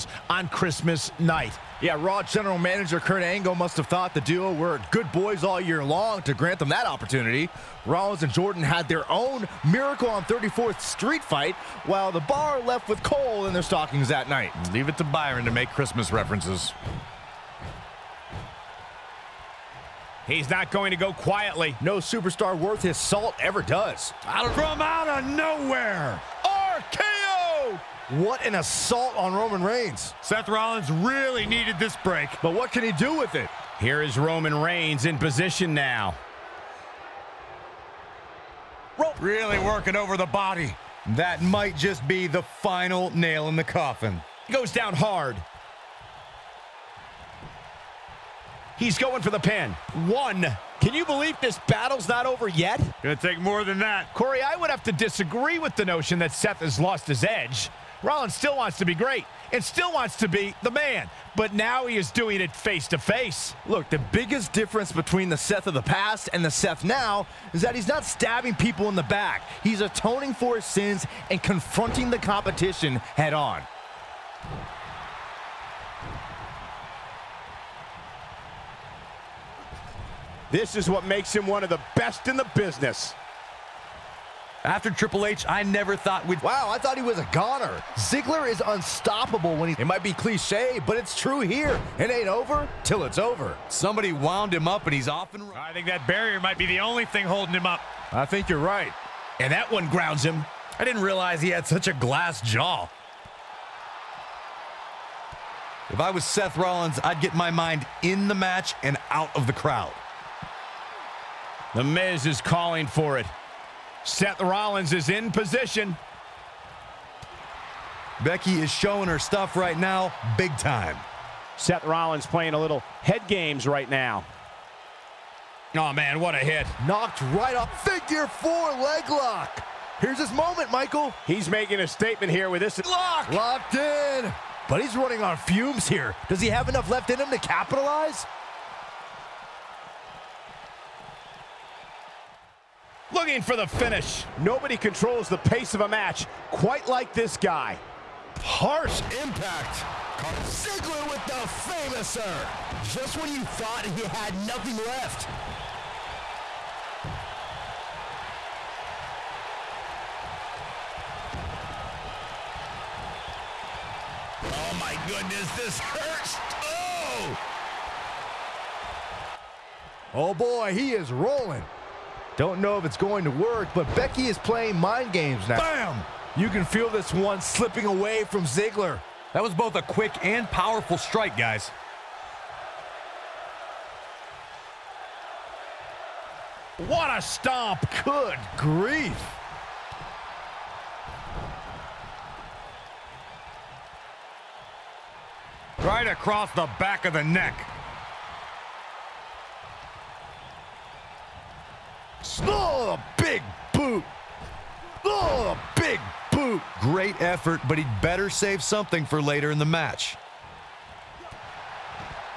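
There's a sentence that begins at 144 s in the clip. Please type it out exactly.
Nobody controls the pace of a match quite like this guy.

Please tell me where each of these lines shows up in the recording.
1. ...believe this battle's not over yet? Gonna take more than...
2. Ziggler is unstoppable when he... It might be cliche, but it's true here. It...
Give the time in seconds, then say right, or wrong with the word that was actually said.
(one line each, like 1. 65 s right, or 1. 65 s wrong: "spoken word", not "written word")
1. 51 s right
2. 87 s right.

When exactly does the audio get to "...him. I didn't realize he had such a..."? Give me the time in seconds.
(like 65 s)
100 s.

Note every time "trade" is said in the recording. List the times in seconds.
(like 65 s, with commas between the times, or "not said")
not said.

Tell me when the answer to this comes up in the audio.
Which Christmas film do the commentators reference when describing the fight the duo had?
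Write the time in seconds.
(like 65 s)
9 s.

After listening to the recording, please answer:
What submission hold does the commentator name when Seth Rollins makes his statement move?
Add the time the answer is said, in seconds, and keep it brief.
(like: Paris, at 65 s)
Figure four leg lock, at 127 s.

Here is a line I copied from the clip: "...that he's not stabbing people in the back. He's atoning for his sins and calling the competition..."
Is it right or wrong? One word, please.
wrong.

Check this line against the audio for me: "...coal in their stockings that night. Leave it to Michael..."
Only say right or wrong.
wrong.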